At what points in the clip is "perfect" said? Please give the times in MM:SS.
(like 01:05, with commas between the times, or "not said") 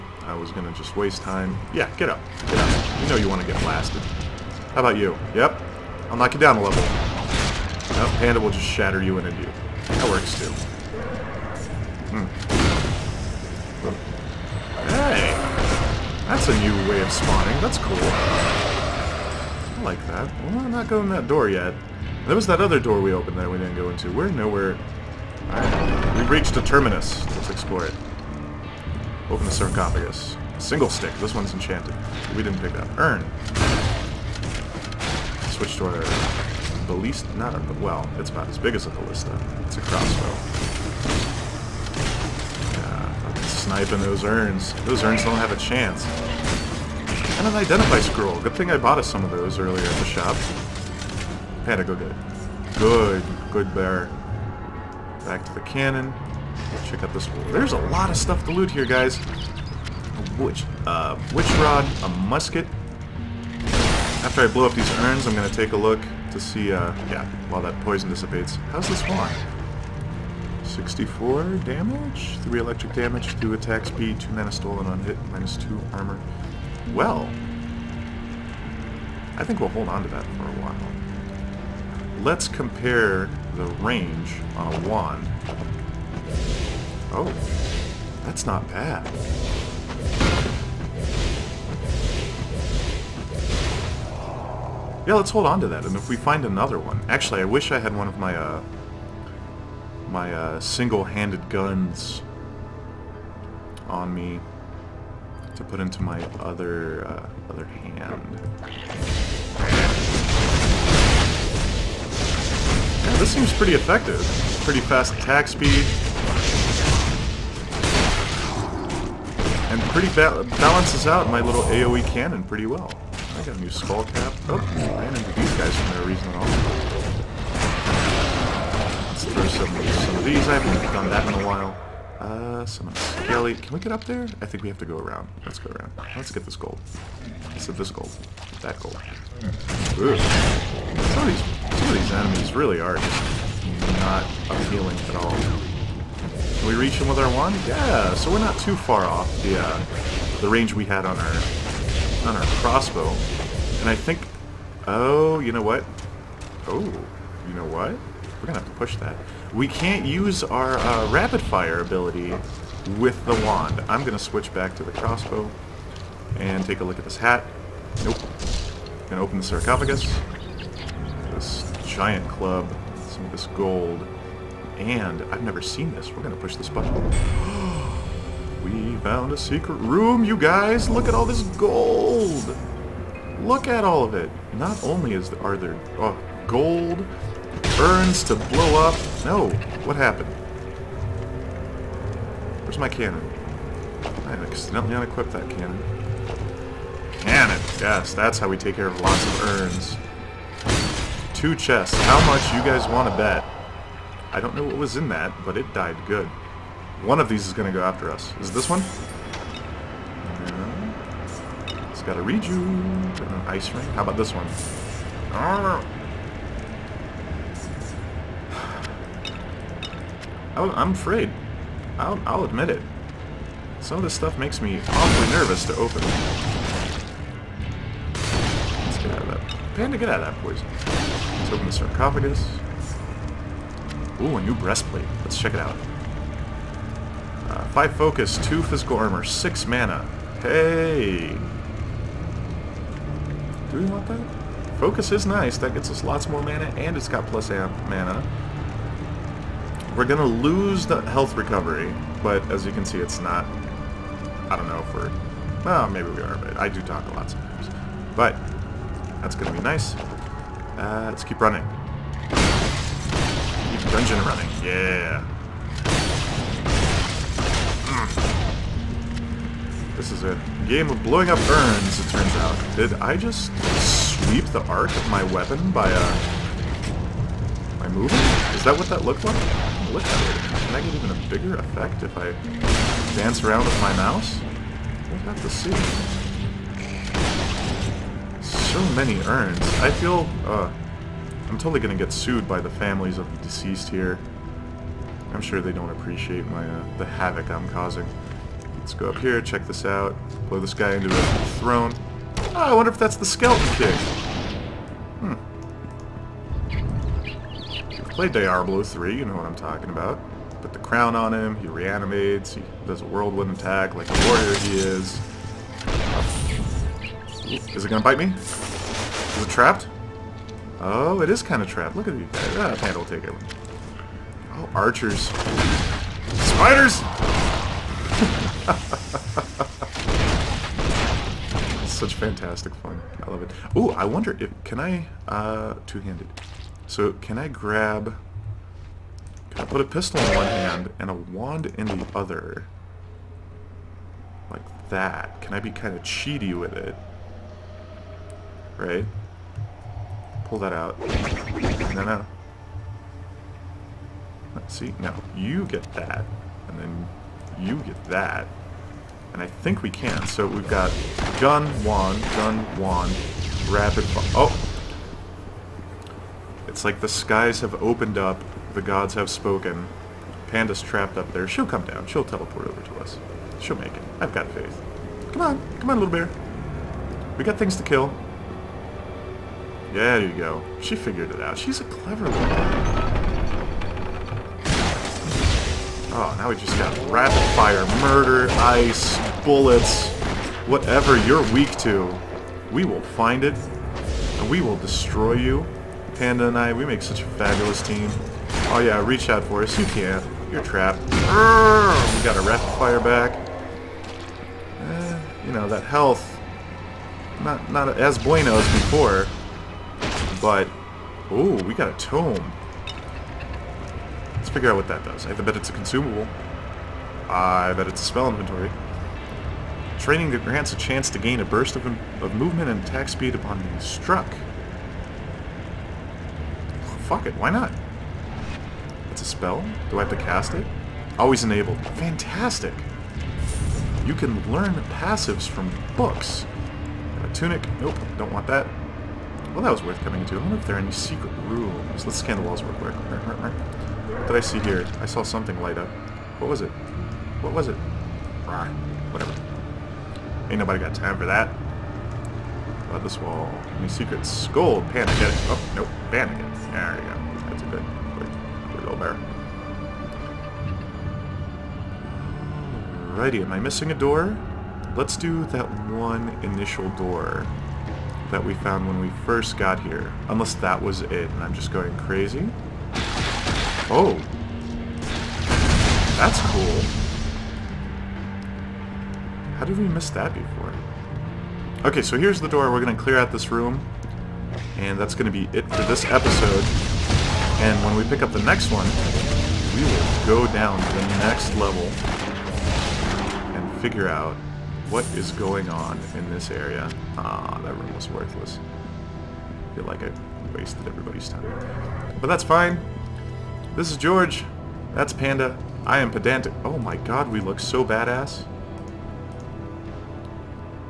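not said.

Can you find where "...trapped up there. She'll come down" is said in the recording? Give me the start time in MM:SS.
06:10.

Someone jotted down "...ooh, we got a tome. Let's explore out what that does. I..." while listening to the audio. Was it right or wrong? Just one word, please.
wrong.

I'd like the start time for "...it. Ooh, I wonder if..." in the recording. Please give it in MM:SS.
05:33.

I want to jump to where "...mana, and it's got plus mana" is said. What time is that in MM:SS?
04:06.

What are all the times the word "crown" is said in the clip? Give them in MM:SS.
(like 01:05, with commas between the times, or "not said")
05:10.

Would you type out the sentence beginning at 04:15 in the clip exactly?
Well, maybe we are, but I do talk a lot sometimes.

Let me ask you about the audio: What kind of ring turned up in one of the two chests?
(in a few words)
An ice ring.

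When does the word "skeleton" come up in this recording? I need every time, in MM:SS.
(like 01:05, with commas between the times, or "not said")
05:03.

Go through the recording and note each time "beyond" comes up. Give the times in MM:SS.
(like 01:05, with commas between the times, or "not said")
not said.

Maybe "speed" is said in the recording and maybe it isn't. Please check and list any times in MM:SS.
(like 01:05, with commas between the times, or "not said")
01:13, 01:55, 07:03.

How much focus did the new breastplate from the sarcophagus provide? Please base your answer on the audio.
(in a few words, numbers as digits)
5.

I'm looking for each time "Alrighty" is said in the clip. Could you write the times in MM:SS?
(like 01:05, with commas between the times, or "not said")
07:43.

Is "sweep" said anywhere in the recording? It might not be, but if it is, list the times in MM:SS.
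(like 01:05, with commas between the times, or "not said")
04:34.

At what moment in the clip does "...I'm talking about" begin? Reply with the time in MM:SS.
05:09.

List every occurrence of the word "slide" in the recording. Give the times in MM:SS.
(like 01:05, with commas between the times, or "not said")
not said.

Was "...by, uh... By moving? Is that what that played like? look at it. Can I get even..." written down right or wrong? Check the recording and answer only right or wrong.
wrong.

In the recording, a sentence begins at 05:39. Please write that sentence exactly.
Can I put a pistol in one hand and a wand in the other?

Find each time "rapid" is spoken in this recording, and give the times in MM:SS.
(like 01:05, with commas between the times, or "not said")
02:41, 06:03, 06:27, 06:42.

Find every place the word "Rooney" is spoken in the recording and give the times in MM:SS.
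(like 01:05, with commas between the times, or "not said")
not said.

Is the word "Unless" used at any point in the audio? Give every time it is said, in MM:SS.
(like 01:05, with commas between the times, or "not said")
07:50.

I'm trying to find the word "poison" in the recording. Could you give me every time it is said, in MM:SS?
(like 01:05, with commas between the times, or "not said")
01:07, 03:50.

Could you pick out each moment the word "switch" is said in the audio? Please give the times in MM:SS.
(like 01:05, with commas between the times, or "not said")
00:35, 02:44.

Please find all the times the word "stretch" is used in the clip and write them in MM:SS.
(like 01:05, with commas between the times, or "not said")
not said.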